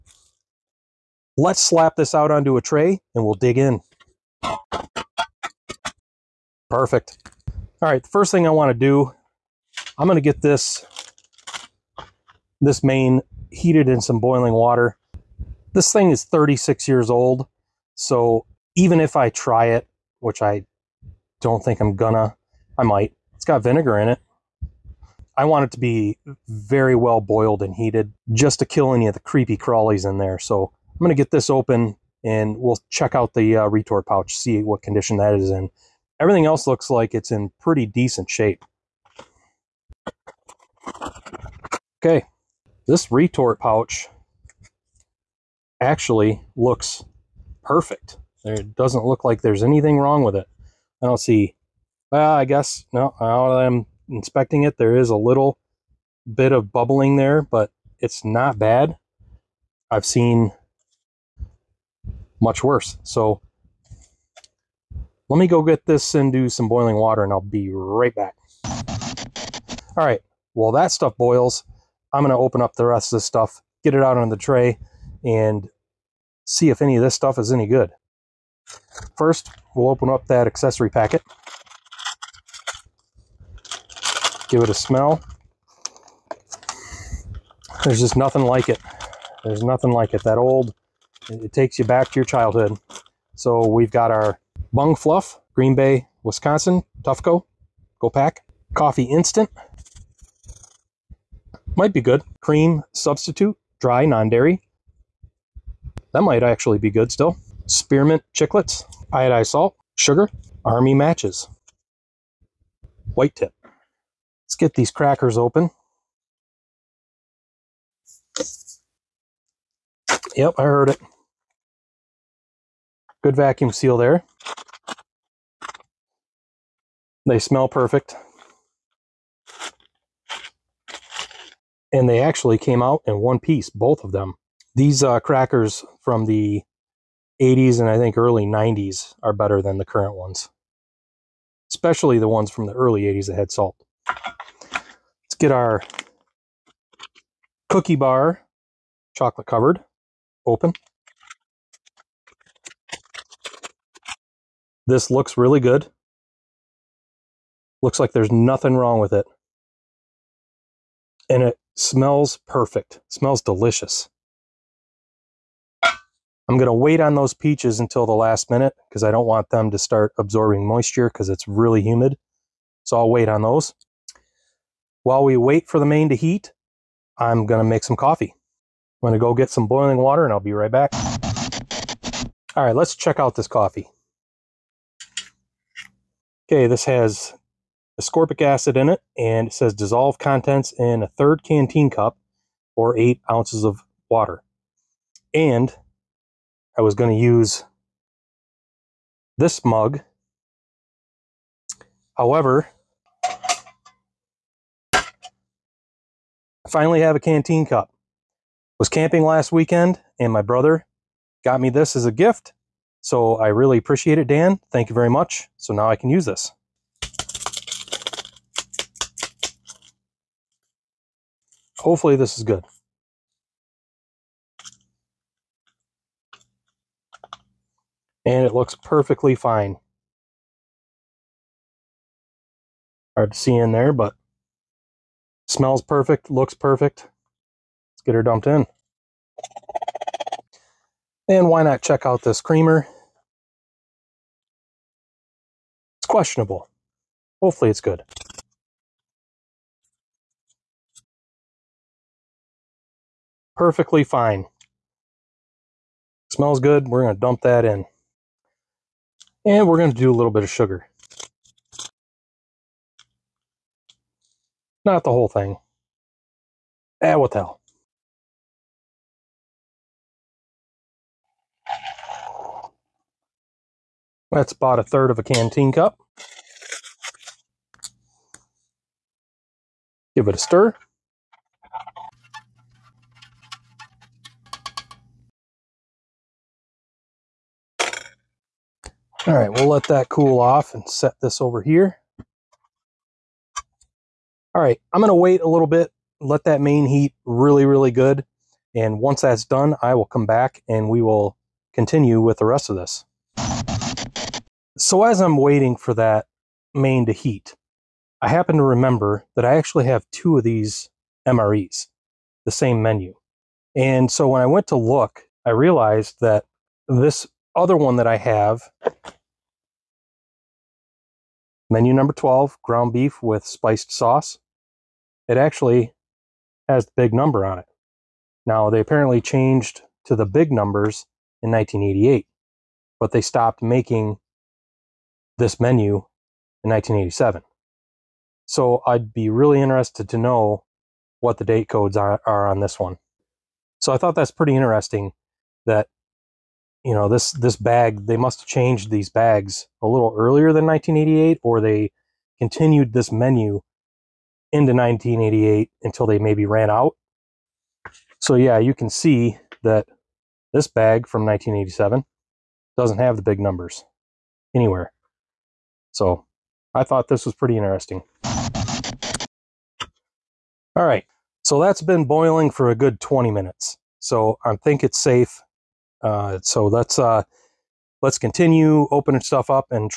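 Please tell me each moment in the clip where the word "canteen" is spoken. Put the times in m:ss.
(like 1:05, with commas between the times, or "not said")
3:11, 3:27, 4:35.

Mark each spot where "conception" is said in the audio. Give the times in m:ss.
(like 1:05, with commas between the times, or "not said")
not said.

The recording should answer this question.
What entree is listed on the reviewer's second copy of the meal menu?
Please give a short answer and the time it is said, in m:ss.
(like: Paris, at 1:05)
ground beef with spiced sauce, at 5:22.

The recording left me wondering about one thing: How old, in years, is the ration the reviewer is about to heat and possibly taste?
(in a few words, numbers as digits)
36.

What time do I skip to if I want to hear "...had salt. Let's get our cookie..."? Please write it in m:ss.
2:23.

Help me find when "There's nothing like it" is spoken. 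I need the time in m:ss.
1:29.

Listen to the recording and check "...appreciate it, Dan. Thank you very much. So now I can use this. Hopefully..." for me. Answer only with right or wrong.
right.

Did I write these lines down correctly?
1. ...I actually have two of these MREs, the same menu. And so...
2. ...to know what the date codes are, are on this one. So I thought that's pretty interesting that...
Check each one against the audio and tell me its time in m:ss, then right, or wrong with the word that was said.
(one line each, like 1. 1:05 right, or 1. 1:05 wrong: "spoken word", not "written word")
1. 5:09 right
2. 5:40 right.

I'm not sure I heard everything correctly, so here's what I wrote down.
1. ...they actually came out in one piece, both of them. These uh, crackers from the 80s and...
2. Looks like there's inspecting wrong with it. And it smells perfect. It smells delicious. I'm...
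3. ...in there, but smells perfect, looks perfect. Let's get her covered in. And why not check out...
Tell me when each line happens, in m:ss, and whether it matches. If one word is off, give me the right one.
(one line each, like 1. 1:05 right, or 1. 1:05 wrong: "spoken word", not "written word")
1. 2:12 right
2. 2:37 wrong: "nothing", not "inspecting"
3. 3:53 wrong: "dumped", not "covered".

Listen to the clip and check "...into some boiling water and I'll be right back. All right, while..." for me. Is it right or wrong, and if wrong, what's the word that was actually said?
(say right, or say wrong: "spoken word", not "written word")
right.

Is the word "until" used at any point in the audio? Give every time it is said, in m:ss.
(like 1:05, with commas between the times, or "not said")
2:47, 5:55.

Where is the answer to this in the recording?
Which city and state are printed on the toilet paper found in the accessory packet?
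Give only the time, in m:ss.
1:35.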